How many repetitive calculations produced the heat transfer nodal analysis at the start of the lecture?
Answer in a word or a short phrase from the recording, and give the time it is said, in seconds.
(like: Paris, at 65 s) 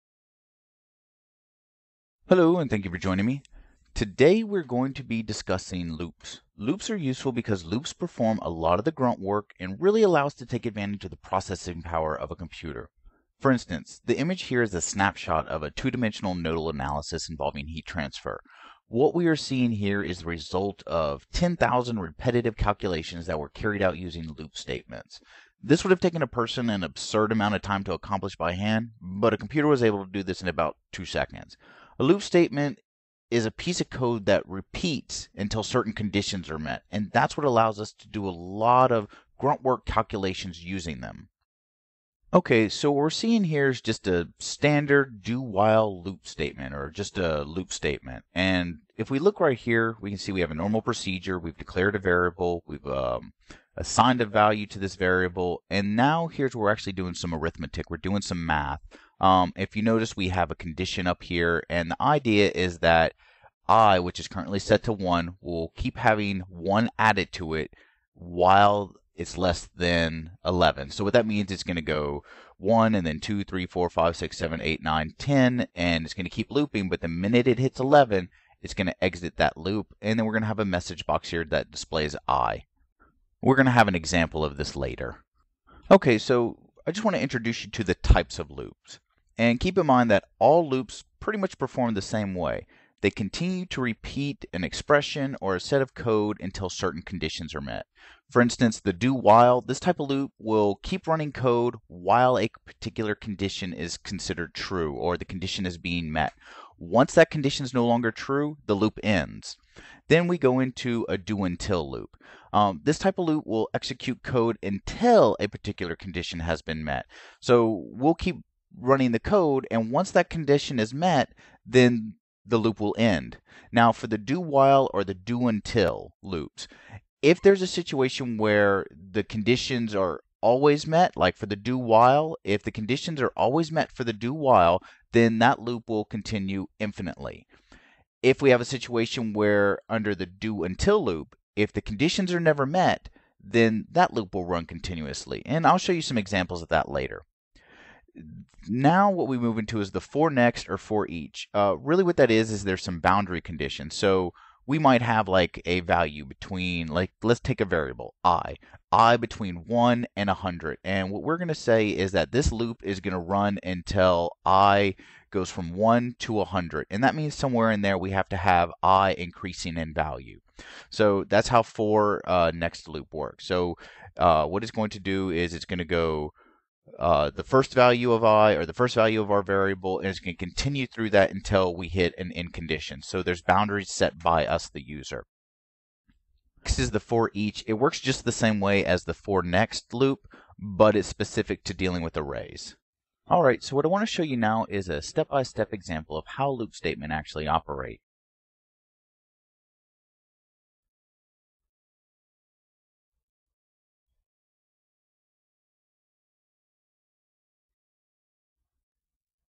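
10,000, at 21 s.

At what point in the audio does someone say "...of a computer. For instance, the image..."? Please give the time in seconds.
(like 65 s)
12 s.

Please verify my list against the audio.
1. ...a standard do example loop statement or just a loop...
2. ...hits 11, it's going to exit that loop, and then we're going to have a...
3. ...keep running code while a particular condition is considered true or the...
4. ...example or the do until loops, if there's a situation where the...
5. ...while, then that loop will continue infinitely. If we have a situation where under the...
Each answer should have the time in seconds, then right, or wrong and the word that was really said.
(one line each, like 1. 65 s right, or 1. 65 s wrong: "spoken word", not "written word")
1. 44 s wrong: "while", not "example"
2. 77 s right
3. 100 s right
4. 124 s wrong: "while", not "example"
5. 134 s right.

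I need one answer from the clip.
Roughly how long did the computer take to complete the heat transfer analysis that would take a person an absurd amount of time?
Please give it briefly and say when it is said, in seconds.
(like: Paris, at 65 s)
about two seconds, at 30 s.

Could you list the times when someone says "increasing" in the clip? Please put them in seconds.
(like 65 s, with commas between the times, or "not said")
169 s.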